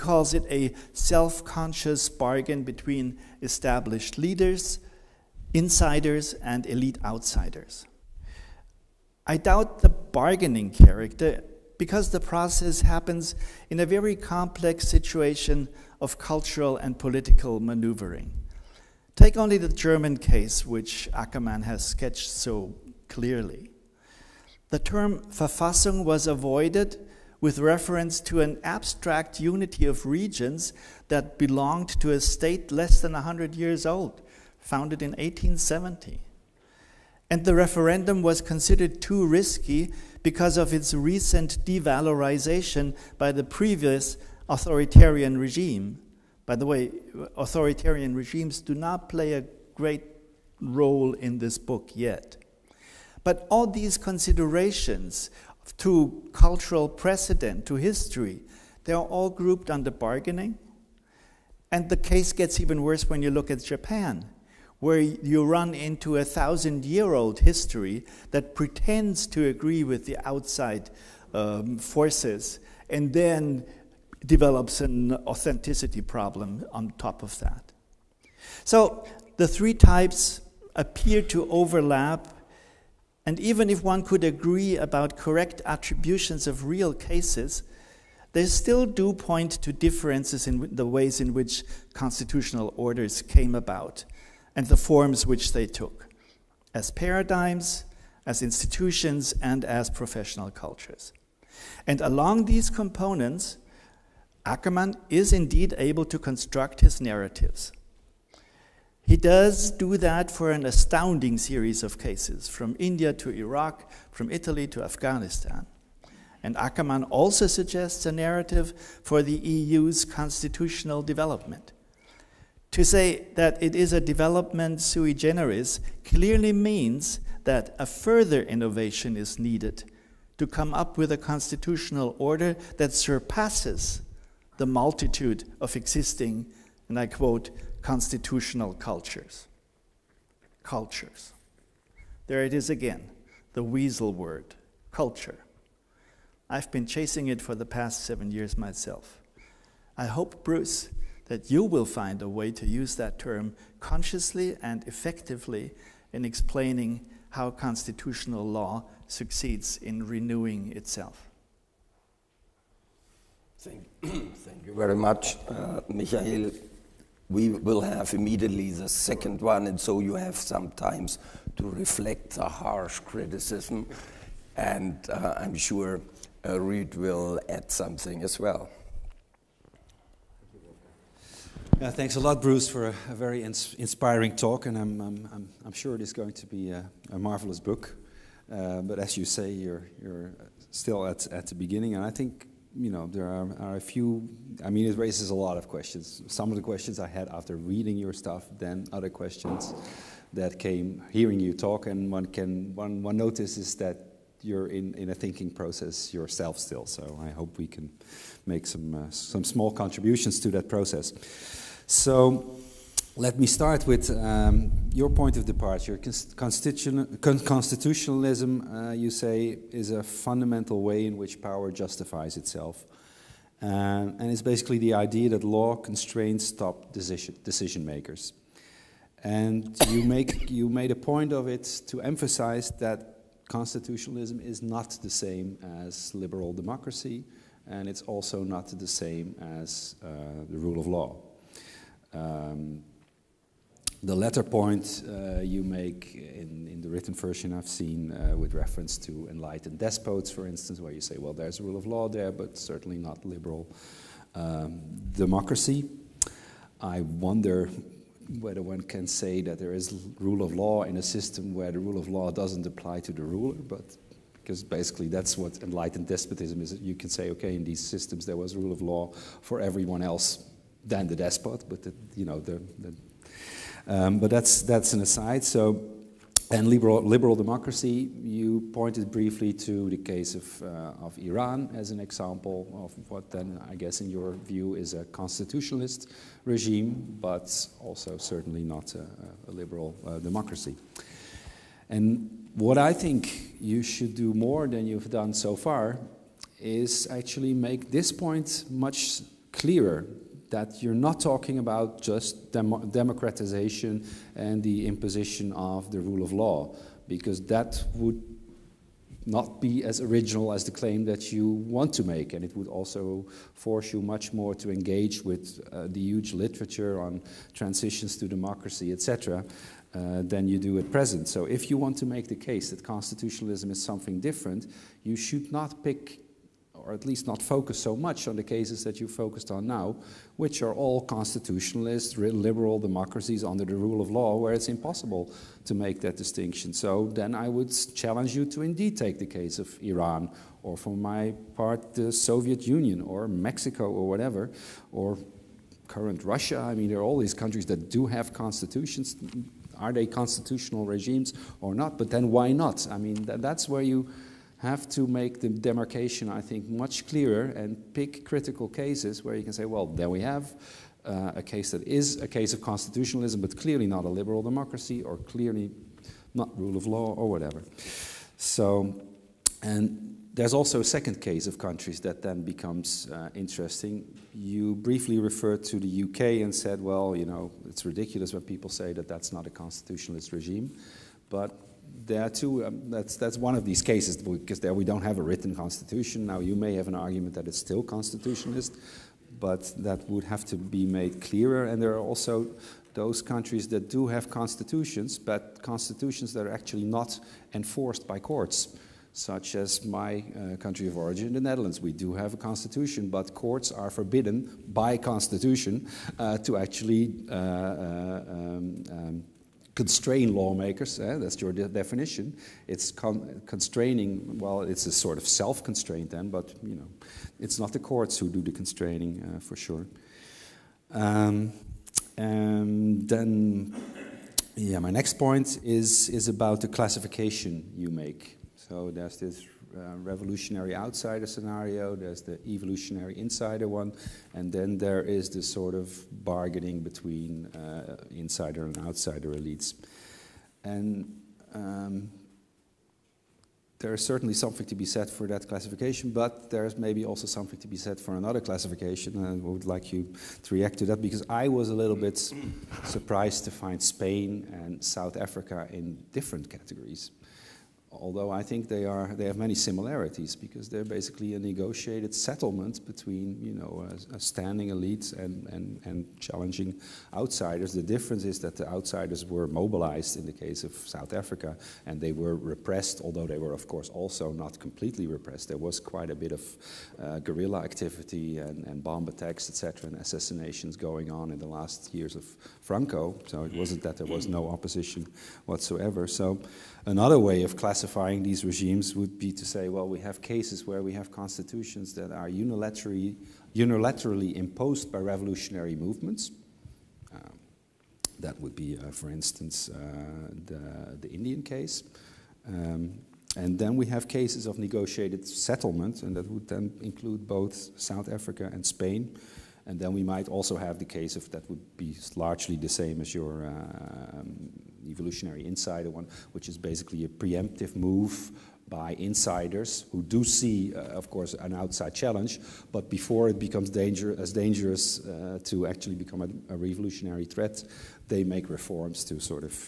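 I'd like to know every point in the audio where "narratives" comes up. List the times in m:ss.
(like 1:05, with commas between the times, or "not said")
1:47, 1:58.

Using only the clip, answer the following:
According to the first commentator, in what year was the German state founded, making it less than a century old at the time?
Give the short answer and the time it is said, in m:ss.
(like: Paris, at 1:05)
1870, at 0:35.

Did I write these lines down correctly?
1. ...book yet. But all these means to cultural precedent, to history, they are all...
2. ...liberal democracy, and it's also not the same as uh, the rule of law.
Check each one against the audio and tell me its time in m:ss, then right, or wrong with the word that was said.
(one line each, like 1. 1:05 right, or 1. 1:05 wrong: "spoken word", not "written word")
1. 0:51 wrong: "considerations", not "means"
2. 3:56 right.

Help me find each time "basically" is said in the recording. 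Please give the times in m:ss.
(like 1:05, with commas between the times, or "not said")
3:44, 4:24, 7:40, 8:36.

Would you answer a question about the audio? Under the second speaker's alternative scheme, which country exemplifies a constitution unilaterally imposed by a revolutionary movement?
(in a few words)
India.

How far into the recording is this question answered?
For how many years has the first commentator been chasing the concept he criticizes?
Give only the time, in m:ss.
2:28.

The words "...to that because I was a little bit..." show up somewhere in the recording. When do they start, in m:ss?
7:30.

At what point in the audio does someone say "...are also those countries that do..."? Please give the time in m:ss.
6:31.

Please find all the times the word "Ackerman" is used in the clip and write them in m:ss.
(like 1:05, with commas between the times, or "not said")
0:21, 1:44, 1:56.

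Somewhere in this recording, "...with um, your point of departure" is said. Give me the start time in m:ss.
3:33.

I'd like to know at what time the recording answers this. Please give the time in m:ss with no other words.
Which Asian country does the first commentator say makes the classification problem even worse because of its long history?
1:03.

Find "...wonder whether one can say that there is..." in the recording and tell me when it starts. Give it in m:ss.
4:17.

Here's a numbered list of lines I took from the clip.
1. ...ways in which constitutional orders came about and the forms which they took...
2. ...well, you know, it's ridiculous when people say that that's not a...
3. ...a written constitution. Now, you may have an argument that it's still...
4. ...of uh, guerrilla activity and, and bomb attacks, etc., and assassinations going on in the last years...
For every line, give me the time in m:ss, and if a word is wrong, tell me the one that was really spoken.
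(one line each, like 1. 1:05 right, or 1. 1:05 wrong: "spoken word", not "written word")
1. 1:30 right
2. 6:16 right
3. 6:25 right
4. 7:56 right.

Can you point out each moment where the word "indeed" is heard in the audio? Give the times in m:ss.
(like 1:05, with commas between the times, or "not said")
1:45, 5:38.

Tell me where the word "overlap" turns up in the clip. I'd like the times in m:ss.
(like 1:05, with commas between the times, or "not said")
1:21.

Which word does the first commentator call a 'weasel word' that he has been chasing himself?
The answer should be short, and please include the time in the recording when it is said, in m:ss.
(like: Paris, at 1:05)
culture, at 2:24.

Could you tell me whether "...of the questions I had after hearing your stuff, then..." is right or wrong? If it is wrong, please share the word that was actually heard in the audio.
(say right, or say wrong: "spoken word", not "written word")
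wrong: "reading", not "hearing".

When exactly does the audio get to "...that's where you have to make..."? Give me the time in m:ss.
5:53.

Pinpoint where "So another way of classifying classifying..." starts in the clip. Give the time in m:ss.
8:06.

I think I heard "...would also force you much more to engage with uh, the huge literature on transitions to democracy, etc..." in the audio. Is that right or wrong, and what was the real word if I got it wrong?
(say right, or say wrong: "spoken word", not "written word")
right.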